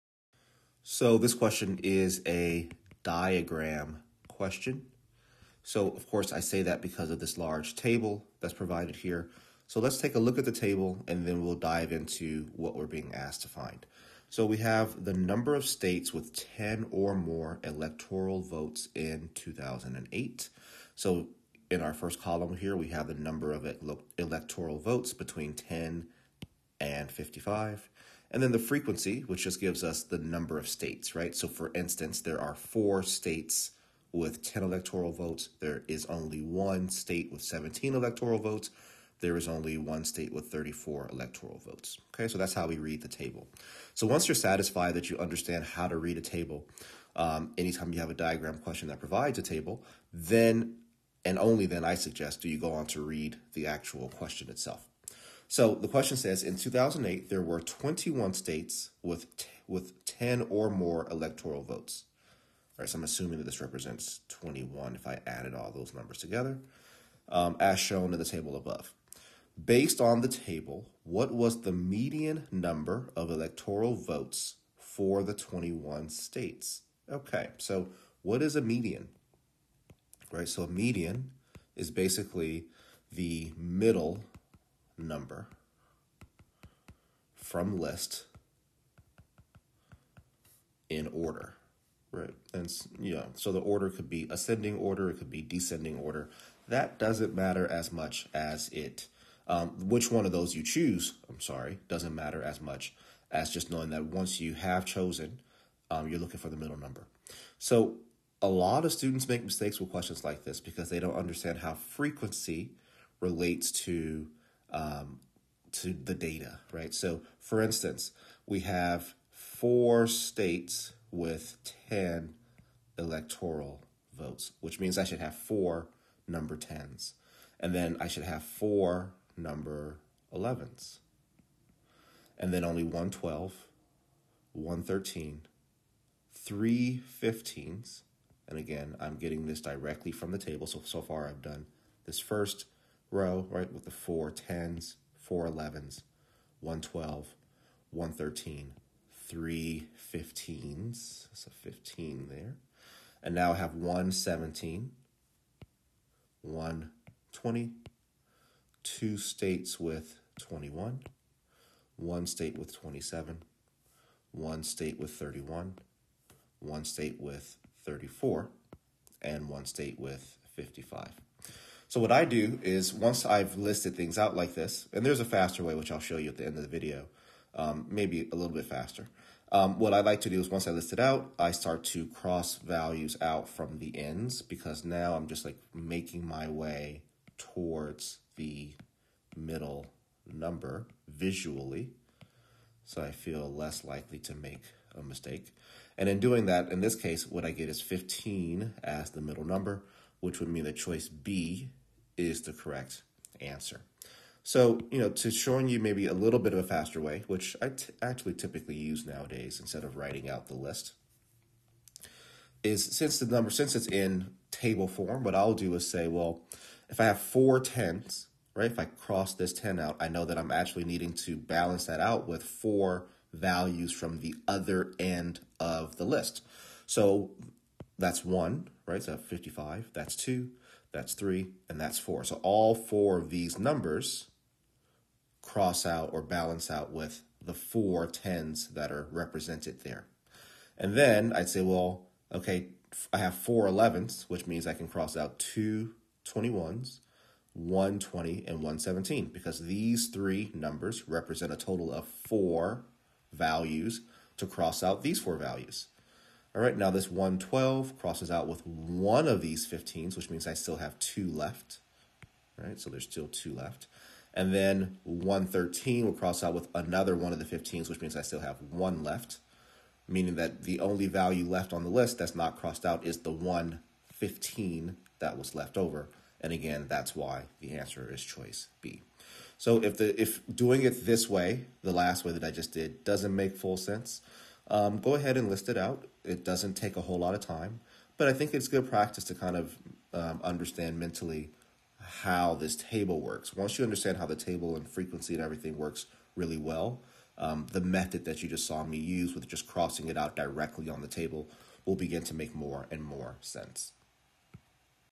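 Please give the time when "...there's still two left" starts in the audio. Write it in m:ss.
4:22.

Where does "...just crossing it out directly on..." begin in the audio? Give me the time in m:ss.
4:59.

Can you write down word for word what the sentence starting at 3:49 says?
So 55, that's two, that's three, and that's four.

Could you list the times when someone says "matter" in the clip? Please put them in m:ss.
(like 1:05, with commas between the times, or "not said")
1:37, 1:42.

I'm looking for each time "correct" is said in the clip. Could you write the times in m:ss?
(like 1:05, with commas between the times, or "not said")
3:22.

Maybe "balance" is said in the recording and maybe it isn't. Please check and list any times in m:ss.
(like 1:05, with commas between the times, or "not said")
3:41, 3:56.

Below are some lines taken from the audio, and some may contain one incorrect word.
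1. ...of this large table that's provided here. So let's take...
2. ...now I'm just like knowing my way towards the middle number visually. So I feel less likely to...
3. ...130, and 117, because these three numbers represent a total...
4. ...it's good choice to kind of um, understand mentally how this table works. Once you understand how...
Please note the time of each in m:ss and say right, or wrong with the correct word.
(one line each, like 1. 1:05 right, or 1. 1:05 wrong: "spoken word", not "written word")
1. 0:07 right
2. 3:04 wrong: "making", not "knowing"
3. 4:07 wrong: "120", not "130"
4. 4:48 wrong: "practice", not "choice".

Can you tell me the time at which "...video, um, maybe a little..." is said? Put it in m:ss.
2:56.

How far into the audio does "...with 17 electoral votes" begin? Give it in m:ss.
0:37.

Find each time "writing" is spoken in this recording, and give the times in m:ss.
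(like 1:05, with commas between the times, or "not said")
3:29.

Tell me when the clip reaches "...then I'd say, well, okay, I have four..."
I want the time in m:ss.
4:00.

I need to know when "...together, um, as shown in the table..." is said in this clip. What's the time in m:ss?
1:06.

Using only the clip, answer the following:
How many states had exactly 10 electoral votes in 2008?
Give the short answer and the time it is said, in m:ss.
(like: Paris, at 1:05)
4, at 0:32.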